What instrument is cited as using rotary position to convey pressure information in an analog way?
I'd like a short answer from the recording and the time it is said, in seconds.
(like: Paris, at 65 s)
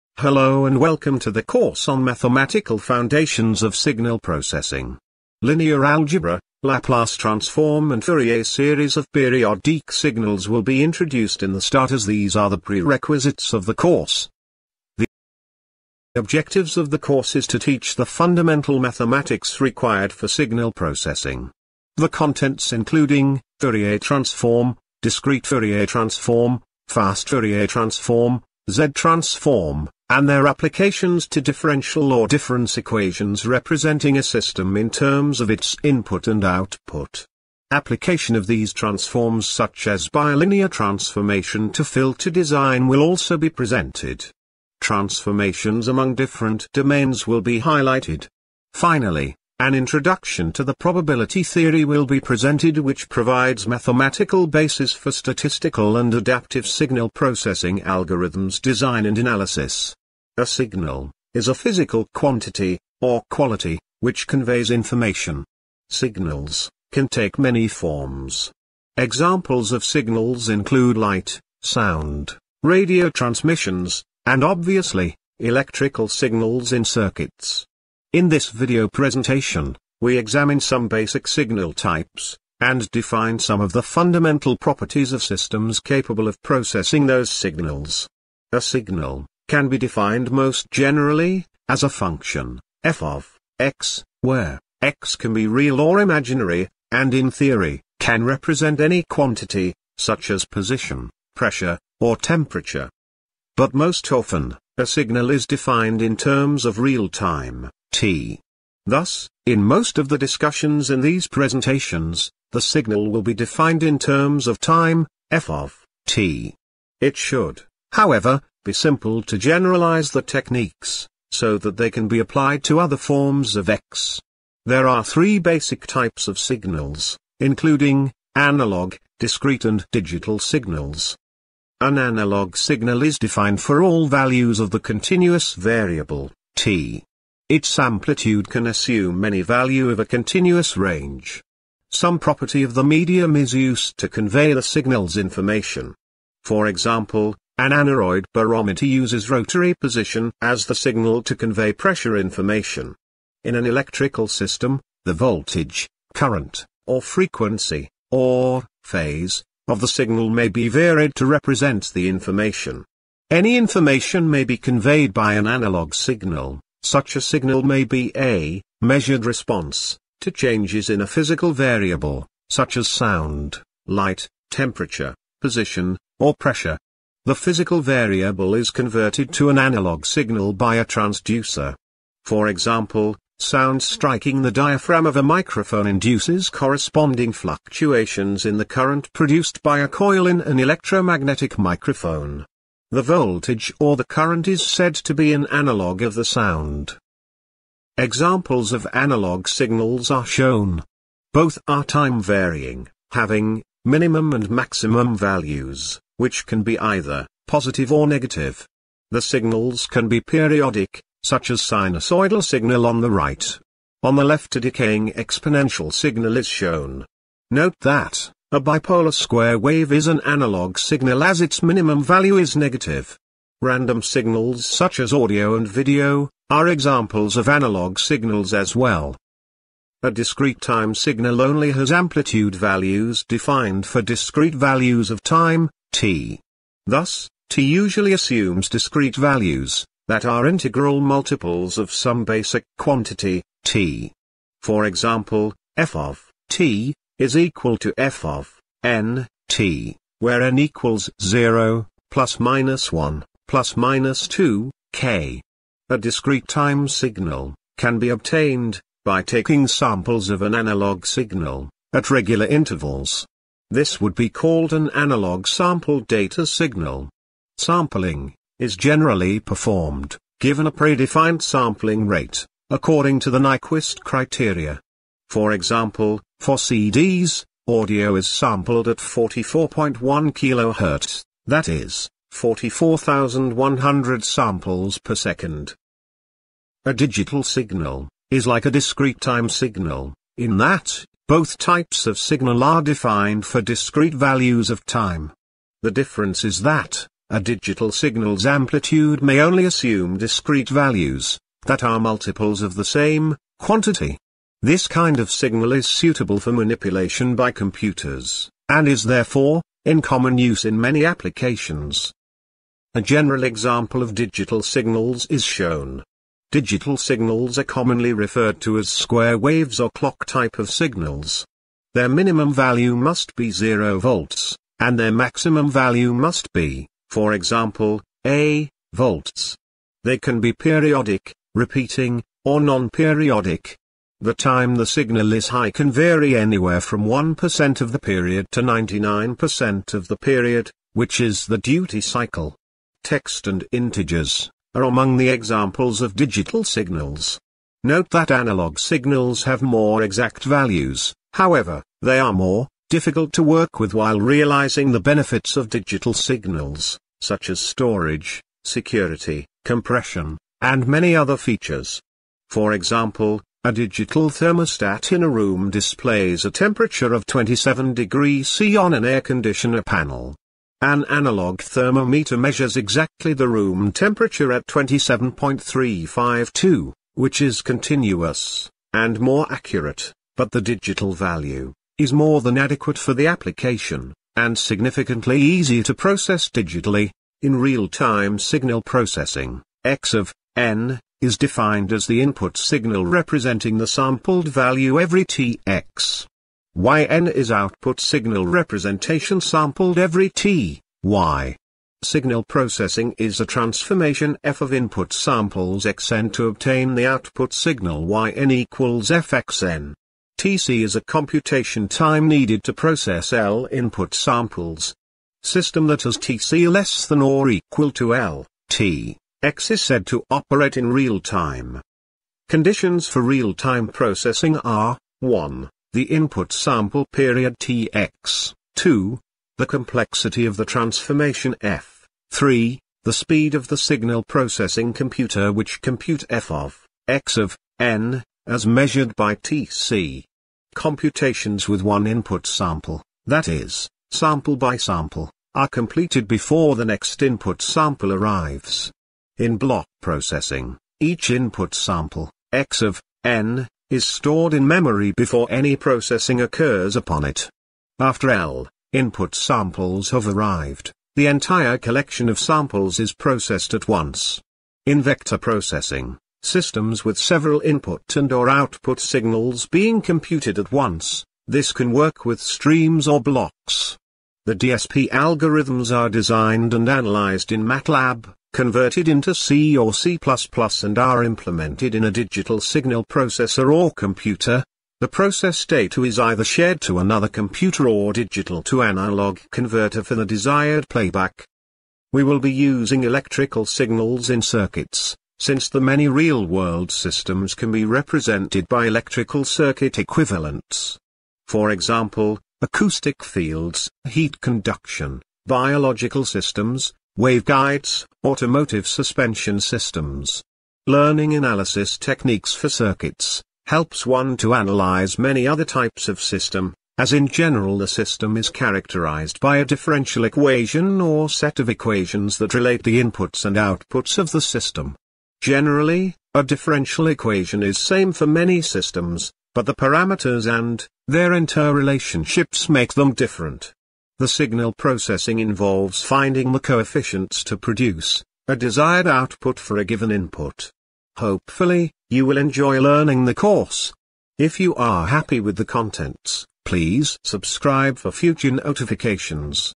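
Aneroid barometer, at 147 s.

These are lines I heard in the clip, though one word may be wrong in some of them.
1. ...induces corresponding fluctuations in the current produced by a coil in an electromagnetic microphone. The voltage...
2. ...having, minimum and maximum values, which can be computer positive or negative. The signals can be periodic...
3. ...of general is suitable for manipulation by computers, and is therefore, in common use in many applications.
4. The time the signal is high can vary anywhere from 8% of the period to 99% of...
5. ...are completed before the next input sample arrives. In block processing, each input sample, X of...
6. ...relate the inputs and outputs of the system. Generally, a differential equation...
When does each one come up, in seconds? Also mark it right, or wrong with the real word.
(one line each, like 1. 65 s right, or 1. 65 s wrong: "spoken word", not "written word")
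1. 185 s right
2. 203 s wrong: "either", not "computer"
3. 305 s wrong: "signal", not "general"
4. 334 s wrong: "1", not "8"
5. 445 s right
6. 522 s right.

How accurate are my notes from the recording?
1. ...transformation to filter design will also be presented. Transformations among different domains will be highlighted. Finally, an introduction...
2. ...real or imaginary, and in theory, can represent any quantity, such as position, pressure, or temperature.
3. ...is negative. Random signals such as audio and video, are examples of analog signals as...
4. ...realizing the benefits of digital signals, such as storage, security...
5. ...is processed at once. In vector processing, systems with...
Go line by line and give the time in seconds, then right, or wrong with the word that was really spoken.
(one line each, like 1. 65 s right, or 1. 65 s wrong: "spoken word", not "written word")
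1. 40 s right
2. 95 s right
3. 222 s right
4. 354 s right
5. 463 s right.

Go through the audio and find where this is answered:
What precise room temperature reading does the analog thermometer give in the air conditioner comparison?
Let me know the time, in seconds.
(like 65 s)
374 s.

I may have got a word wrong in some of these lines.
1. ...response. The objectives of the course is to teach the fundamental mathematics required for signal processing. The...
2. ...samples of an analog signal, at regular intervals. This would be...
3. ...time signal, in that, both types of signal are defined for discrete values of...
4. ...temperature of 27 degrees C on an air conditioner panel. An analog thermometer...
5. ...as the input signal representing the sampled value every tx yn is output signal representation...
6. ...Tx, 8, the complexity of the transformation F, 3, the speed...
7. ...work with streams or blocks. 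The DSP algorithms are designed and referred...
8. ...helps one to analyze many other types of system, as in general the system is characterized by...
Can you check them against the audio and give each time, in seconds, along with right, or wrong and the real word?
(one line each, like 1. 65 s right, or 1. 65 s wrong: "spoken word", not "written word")
1. 13 s wrong: "course", not "response"
2. 259 s right
3. 289 s right
4. 366 s right
5. 391 s right
6. 427 s wrong: "2", not "8"
7. 471 s wrong: "analyzed", not "referred"
8. 513 s right.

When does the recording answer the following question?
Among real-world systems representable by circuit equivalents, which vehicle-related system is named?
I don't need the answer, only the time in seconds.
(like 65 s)
508 s.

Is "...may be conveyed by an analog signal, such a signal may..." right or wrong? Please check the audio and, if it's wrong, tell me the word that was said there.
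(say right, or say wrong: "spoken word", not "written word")
right.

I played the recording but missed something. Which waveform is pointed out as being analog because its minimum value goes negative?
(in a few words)
Bipolar square wave.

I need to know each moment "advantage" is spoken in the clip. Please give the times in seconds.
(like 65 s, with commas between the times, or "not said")
not said.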